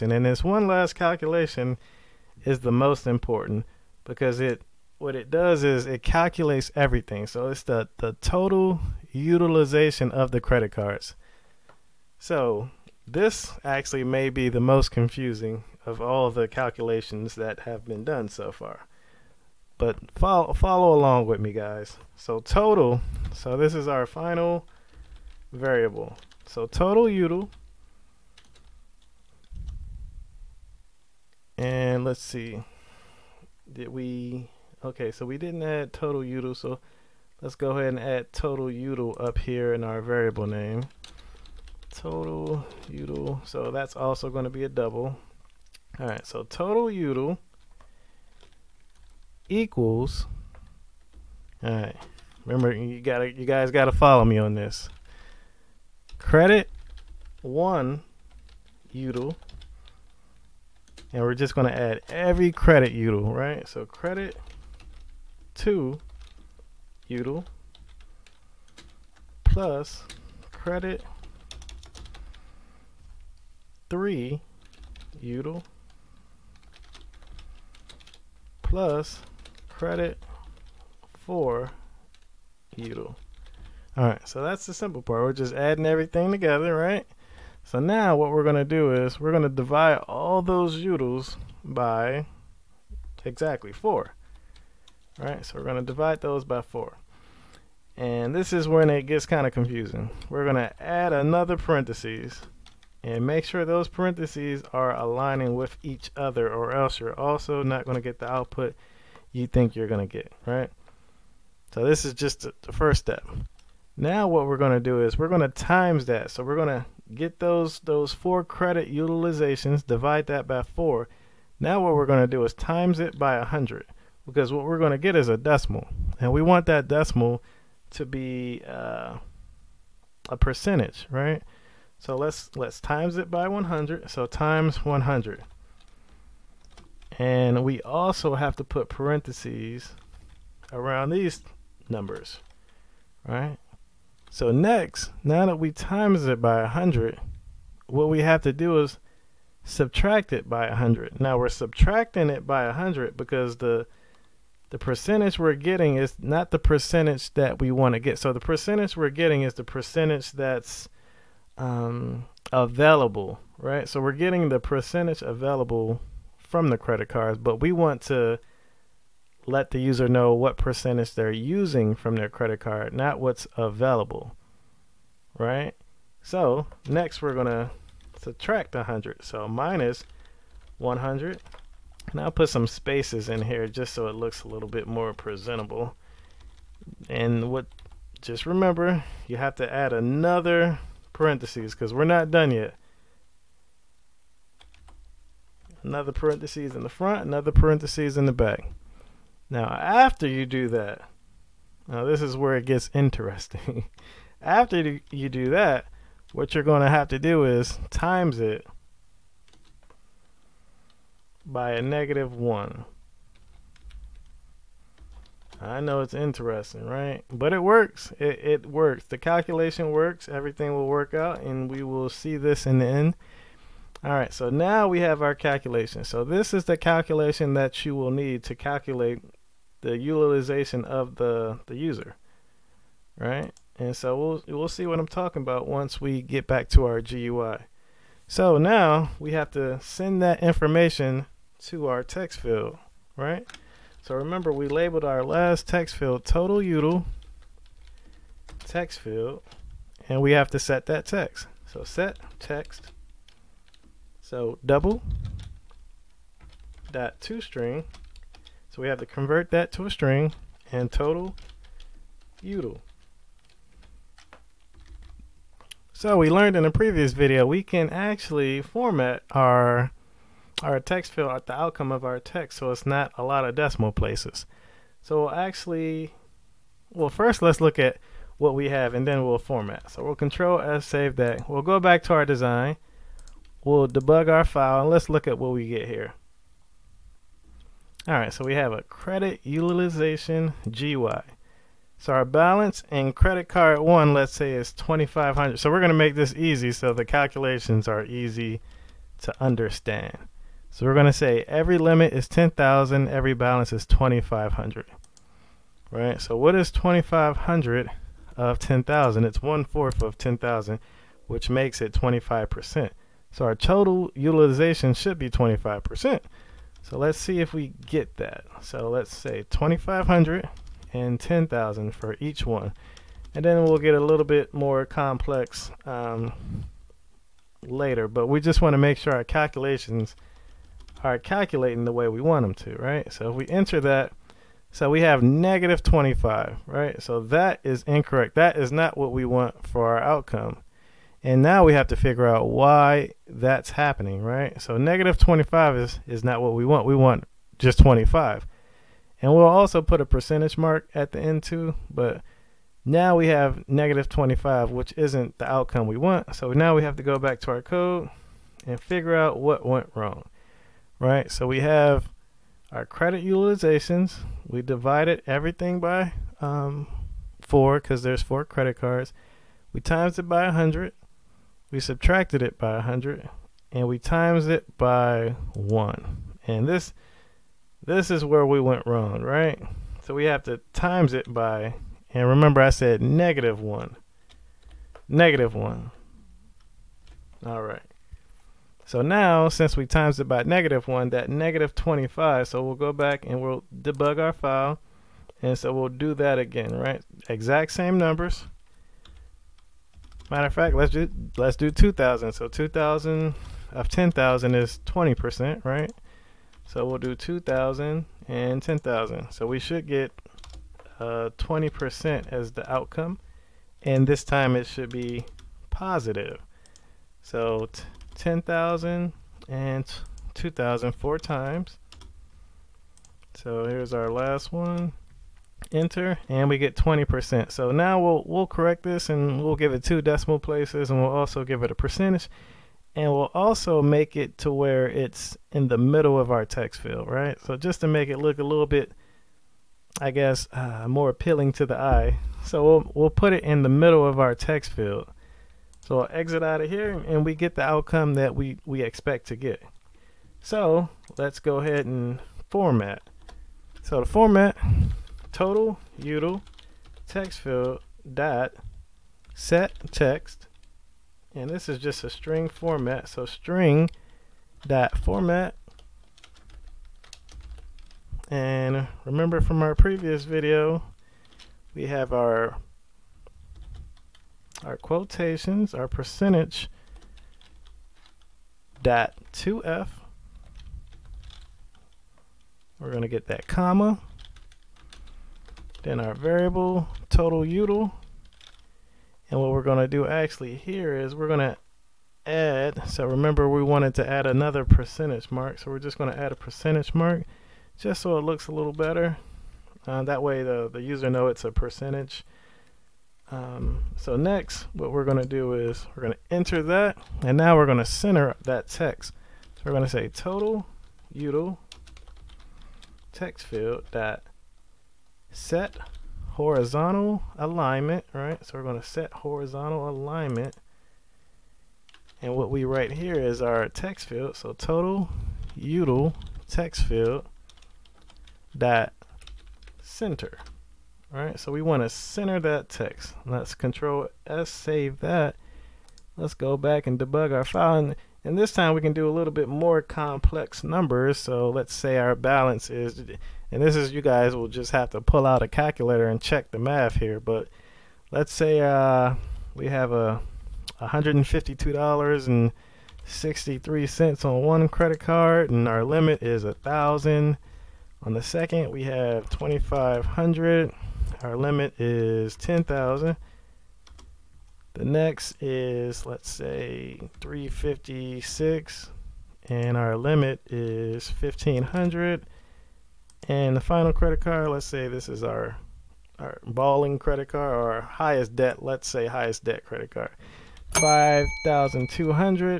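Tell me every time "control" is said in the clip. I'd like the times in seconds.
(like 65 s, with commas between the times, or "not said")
280 s, 533 s.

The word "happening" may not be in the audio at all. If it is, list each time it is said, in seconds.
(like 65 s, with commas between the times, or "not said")
343 s.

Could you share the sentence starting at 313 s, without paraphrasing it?
So our total utilization should be 25%.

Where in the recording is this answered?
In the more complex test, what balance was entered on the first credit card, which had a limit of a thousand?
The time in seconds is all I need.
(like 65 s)
550 s.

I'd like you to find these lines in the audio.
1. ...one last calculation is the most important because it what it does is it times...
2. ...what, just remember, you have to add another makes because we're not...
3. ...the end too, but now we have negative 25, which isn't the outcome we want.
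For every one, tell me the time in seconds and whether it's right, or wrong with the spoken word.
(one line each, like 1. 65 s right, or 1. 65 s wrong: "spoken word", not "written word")
1. 0 s wrong: "calculates", not "times"
2. 187 s wrong: "parentheses", not "makes"
3. 351 s right.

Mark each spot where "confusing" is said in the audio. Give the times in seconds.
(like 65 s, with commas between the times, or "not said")
14 s, 99 s.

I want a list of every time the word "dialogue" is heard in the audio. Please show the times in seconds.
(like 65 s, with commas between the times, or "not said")
not said.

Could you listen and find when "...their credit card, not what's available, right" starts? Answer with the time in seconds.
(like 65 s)
172 s.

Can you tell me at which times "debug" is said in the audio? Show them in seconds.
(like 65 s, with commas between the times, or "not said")
283 s, 393 s, 536 s.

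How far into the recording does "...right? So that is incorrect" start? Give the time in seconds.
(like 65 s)
336 s.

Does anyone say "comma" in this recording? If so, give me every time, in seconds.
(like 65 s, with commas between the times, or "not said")
483 s.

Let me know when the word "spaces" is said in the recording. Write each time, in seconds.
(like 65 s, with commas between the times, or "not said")
182 s.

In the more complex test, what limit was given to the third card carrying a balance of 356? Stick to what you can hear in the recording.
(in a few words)
1,500.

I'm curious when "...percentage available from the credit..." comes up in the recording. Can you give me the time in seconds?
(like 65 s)
164 s.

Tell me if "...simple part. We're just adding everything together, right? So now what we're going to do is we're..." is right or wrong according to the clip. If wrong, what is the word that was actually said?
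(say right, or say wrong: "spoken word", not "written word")
right.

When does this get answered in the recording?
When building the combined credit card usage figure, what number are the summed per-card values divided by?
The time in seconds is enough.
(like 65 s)
93 s.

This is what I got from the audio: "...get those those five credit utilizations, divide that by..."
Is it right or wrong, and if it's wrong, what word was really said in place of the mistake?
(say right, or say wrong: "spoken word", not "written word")
wrong: "four", not "five".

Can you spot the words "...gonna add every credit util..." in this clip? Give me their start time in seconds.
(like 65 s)
61 s.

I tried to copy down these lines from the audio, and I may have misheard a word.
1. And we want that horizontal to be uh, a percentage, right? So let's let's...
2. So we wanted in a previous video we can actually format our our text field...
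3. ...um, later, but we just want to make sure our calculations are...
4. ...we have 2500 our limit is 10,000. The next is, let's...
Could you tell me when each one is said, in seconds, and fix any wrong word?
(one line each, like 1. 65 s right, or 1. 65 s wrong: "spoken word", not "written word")
1. 126 s wrong: "decimal", not "horizontal"
2. 265 s wrong: "learned", not "wanted"
3. 325 s right
4. 558 s right.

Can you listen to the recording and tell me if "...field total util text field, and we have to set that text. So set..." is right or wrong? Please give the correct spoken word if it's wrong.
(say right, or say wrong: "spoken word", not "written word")
right.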